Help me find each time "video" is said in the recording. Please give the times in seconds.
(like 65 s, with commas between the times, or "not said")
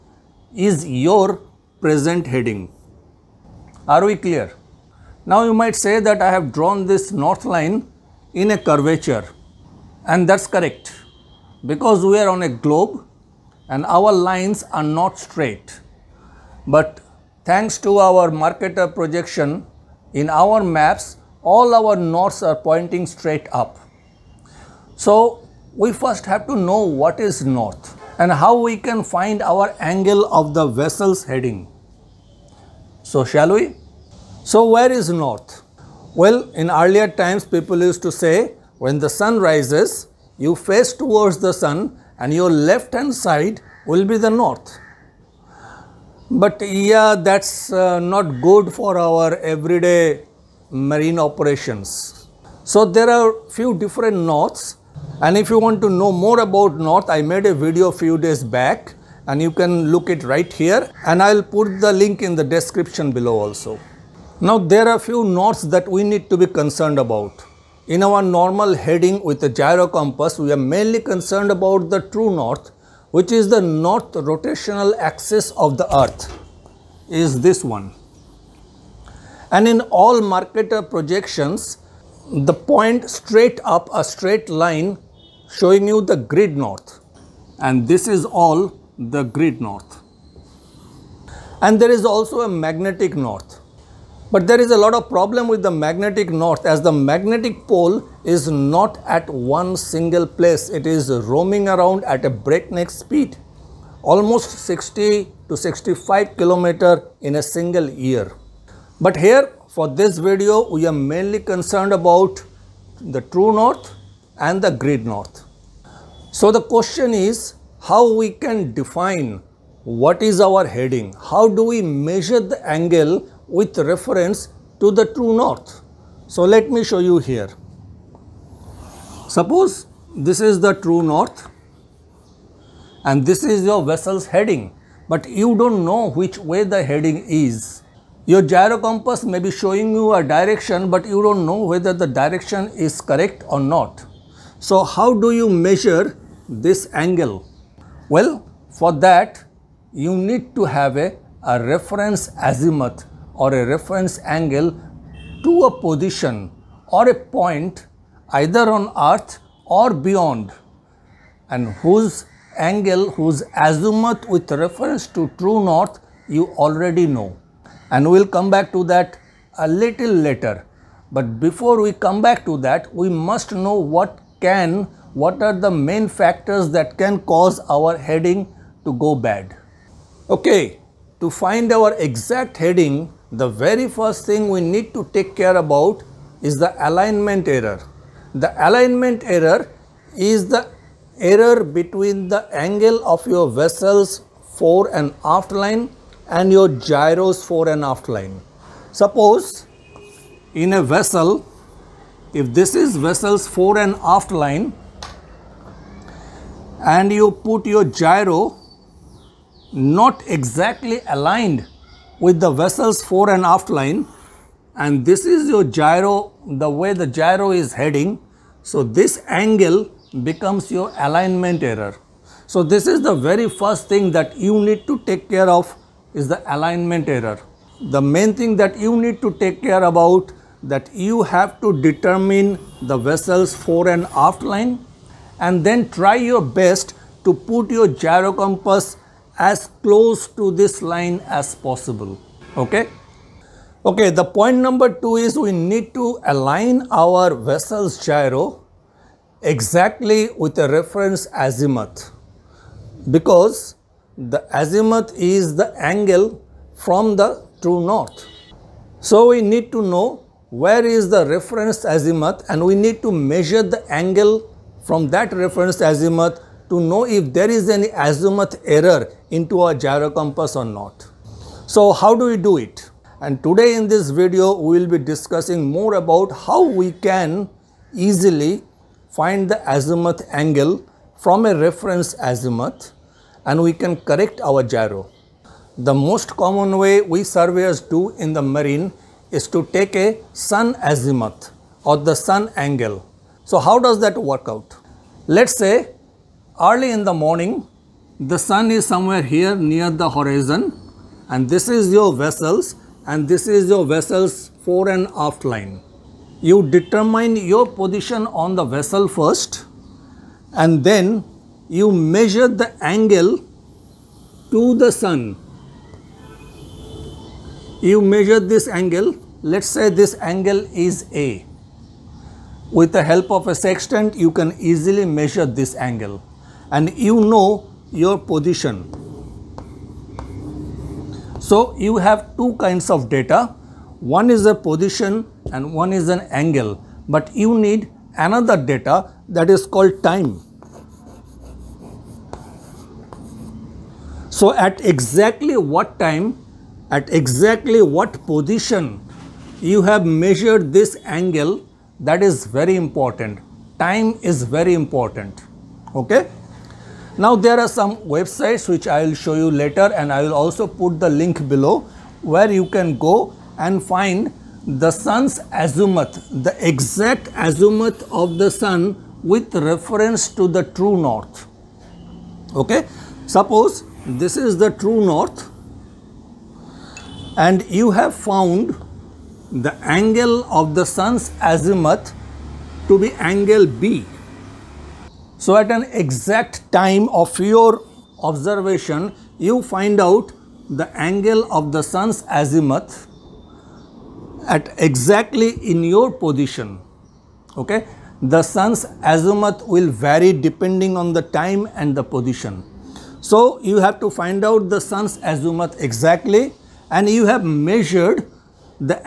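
57 s, 110 s, 274 s.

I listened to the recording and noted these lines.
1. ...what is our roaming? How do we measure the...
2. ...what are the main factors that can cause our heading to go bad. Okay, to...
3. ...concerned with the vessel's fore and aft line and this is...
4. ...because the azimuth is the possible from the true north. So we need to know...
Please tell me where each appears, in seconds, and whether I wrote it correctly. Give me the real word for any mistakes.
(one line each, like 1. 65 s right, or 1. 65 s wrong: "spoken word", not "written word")
1. 119 s wrong: "heading", not "roaming"
2. 175 s right
3. 211 s wrong: "aligned", not "concerned"
4. 253 s wrong: "angle", not "possible".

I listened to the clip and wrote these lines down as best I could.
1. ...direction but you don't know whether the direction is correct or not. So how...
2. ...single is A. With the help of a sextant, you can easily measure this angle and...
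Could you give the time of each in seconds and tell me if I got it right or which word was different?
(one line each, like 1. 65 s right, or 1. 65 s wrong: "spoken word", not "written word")
1. 140 s right
2. 320 s wrong: "angle", not "single".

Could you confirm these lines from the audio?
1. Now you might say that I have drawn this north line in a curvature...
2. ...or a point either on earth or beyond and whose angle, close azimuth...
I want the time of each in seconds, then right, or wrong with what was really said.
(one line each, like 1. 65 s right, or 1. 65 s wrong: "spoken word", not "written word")
1. 5 s right
2. 156 s wrong: "whose", not "close".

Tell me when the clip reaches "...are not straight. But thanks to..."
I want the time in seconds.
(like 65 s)
14 s.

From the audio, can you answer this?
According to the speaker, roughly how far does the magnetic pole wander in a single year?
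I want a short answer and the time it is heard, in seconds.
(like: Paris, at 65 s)
60 to 65 km, at 104 s.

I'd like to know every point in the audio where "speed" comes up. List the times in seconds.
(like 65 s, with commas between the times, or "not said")
102 s.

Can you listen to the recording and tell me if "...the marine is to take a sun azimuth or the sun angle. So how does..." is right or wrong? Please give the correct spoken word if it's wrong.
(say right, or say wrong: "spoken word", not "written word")
right.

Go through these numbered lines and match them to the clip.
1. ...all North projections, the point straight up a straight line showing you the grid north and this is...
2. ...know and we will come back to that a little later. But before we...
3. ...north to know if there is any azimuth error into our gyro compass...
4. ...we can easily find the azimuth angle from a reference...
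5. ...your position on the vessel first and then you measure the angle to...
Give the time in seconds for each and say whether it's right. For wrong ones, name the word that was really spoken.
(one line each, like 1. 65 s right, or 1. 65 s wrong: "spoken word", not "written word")
1. 79 s wrong: "Mercator", not "North"
2. 167 s right
3. 265 s wrong: "azimuth", not "north"
4. 276 s right
5. 307 s right.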